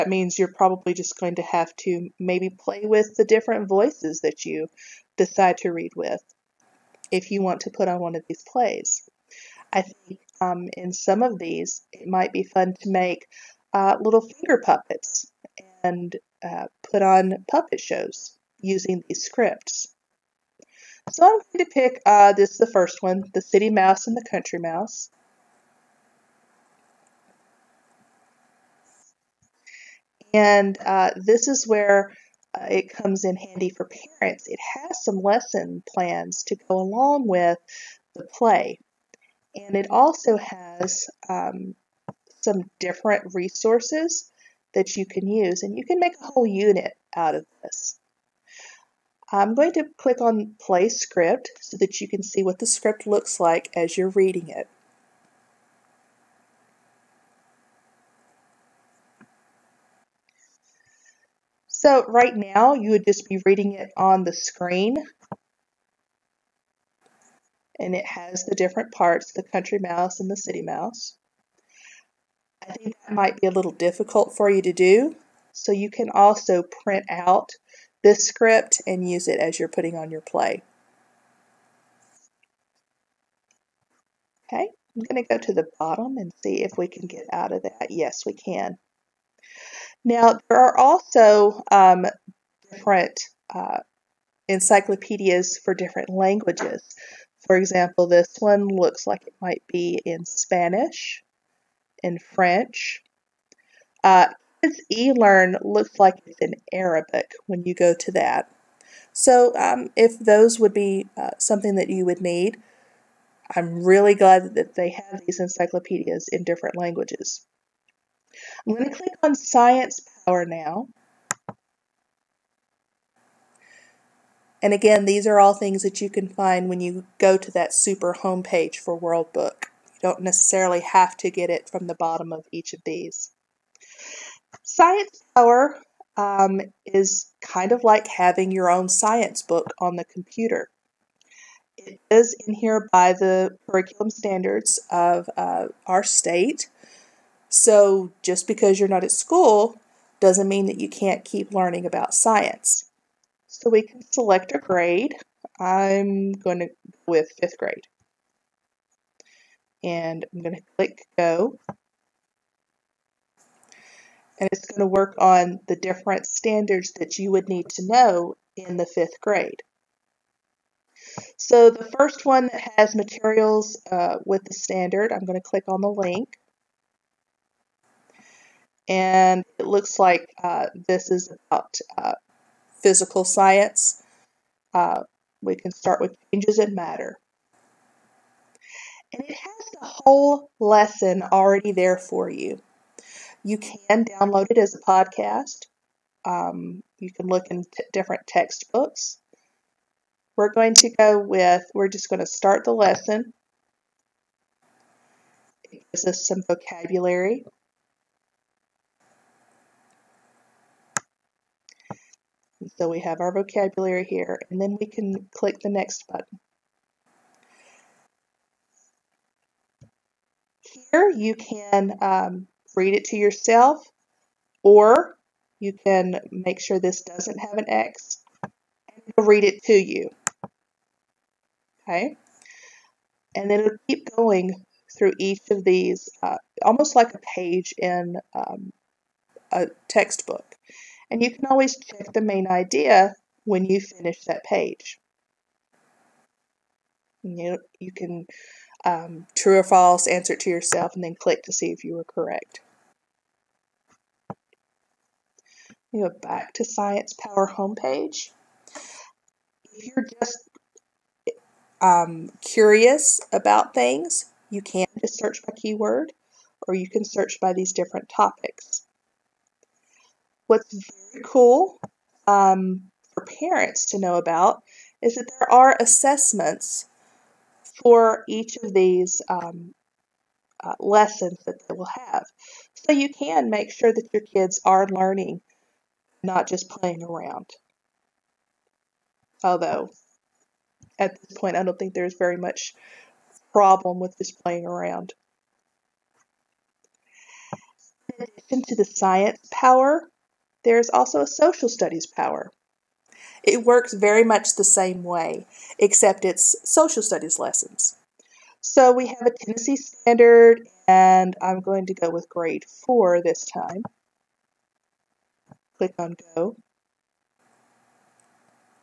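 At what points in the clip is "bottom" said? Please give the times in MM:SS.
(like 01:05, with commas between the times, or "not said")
01:25, 02:11.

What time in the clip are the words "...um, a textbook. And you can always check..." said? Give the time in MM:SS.
03:58.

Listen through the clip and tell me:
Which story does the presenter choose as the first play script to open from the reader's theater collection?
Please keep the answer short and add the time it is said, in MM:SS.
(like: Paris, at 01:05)
The City Mouse and the Country Mouse, at 00:23.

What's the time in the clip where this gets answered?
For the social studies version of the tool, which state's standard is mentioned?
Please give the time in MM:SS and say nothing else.
05:09.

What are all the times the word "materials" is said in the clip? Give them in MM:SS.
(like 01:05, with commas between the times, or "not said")
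02:52.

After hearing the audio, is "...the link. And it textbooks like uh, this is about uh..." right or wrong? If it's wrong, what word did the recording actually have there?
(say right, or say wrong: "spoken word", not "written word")
wrong: "looks", not "textbooks".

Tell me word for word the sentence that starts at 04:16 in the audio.
go back to Science Power homepage.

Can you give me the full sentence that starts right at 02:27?
So just because you're not at school doesn't mean that you can't keep learning about science.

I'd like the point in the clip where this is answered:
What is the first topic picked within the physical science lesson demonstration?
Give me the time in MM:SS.
03:06.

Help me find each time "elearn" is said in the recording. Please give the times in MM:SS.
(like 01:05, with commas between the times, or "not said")
01:44.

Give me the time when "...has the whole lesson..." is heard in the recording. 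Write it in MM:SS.
03:09.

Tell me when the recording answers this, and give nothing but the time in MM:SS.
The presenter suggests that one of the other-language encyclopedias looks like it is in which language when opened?
01:46.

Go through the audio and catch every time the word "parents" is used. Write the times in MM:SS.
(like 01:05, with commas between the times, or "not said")
00:34, 04:33.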